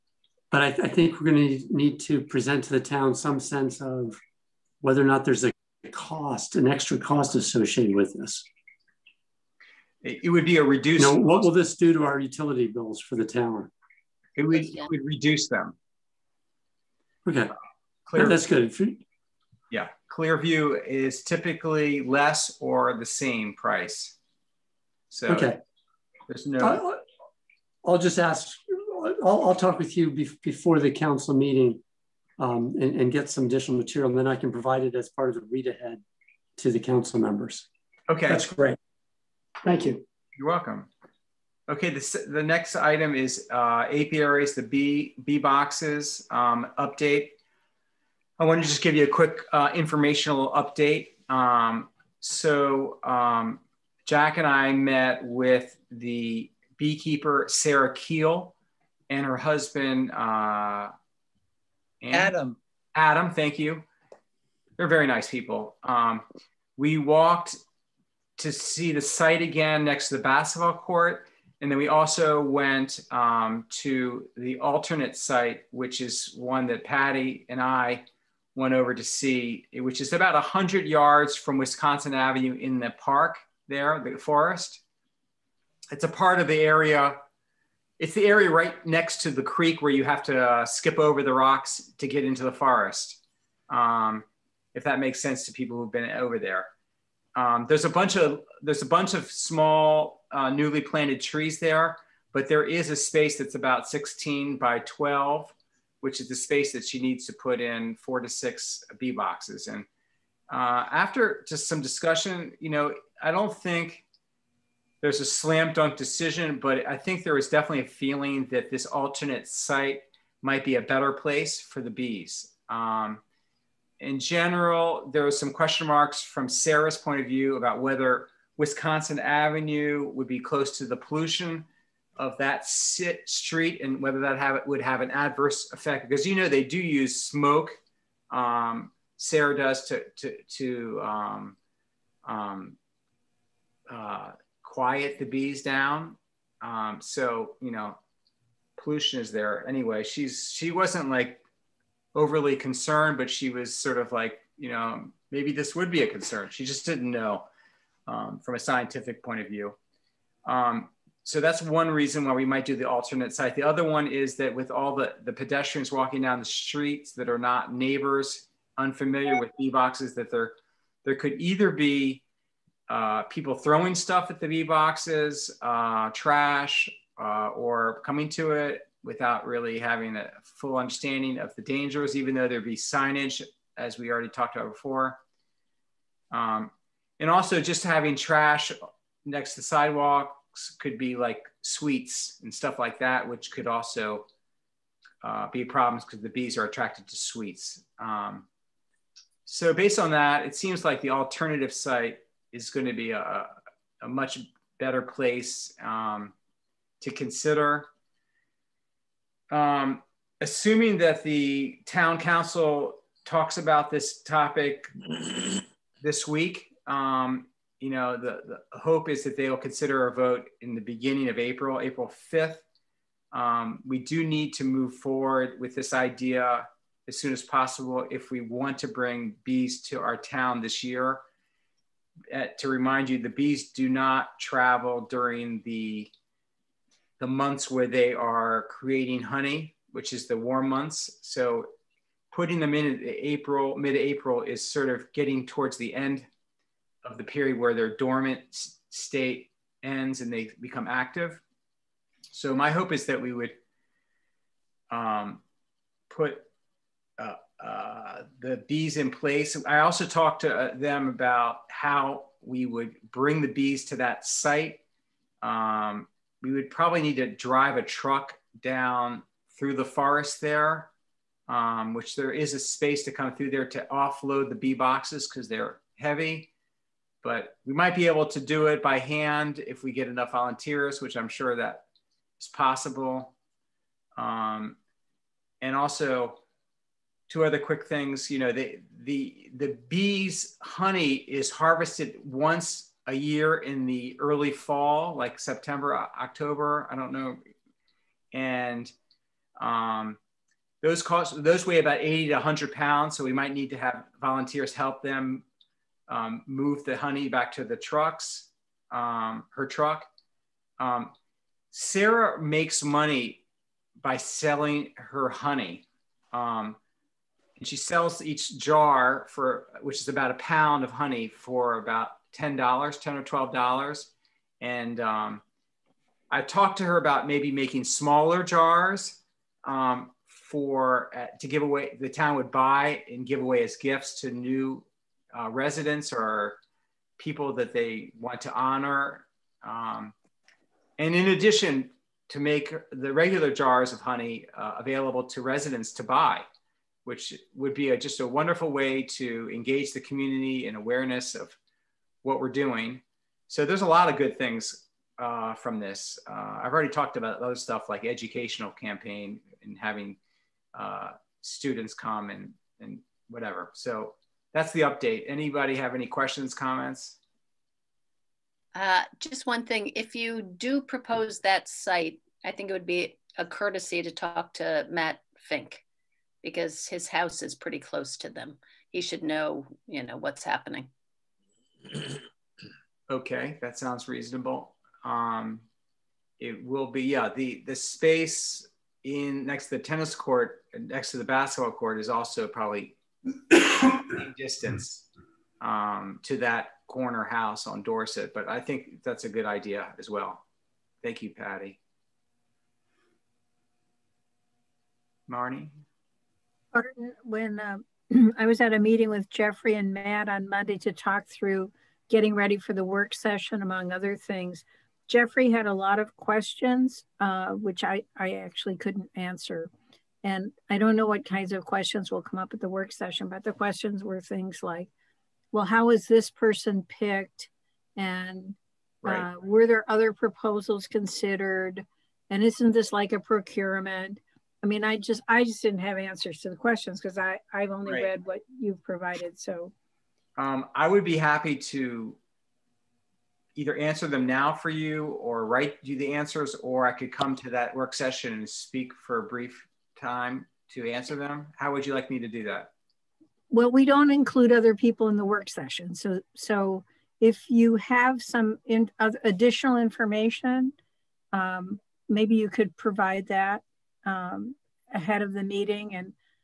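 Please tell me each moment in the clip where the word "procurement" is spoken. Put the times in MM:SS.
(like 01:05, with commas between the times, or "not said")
07:13.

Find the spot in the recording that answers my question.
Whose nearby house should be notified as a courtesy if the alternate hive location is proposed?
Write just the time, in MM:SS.
06:14.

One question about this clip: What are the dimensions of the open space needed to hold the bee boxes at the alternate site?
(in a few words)
16 by 12.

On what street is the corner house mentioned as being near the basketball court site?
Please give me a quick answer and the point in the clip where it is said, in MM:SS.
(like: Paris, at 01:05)
Dorset, at 06:37.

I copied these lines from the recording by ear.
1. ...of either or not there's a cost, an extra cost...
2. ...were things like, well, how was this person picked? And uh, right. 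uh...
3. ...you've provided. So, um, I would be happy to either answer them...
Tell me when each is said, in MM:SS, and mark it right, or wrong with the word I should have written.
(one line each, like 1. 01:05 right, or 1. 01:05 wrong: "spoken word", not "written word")
1. 00:03 wrong: "whether", not "either"
2. 07:04 right
3. 07:18 right.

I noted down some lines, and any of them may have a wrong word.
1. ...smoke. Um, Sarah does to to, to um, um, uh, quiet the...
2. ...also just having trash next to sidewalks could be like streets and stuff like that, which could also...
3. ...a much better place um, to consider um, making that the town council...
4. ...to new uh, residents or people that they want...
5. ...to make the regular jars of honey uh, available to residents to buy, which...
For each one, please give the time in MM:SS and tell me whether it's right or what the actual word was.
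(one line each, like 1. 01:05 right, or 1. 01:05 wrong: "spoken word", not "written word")
1. 02:17 right
2. 03:07 wrong: "sweets", not "streets"
3. 03:24 wrong: "assuming", not "making"
4. 05:34 right
5. 05:42 right.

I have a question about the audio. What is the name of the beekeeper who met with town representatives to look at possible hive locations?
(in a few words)
Sarah Keel.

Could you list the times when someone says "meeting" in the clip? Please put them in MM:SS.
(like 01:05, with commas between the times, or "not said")
00:31, 06:48, 07:45.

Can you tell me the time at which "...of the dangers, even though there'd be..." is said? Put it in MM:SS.
03:01.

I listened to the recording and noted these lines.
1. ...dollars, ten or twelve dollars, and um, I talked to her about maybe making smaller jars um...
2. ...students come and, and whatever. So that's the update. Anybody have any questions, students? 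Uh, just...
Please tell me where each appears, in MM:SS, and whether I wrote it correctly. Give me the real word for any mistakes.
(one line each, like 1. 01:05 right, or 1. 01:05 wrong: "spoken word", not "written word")
1. 05:22 right
2. 06:01 wrong: "comments", not "students".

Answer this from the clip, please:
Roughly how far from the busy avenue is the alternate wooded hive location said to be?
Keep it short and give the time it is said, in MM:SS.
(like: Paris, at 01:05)
100 yards, at 01:20.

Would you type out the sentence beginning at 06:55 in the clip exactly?
Jeffrey had a lot of questions, uh, which I, I actually couldn't answer.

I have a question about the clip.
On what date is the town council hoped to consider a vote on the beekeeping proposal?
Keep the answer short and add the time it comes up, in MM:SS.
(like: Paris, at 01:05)
April 5th, at 03:41.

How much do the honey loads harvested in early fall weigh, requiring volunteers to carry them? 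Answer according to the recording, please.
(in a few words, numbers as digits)
80 to 100 pounds.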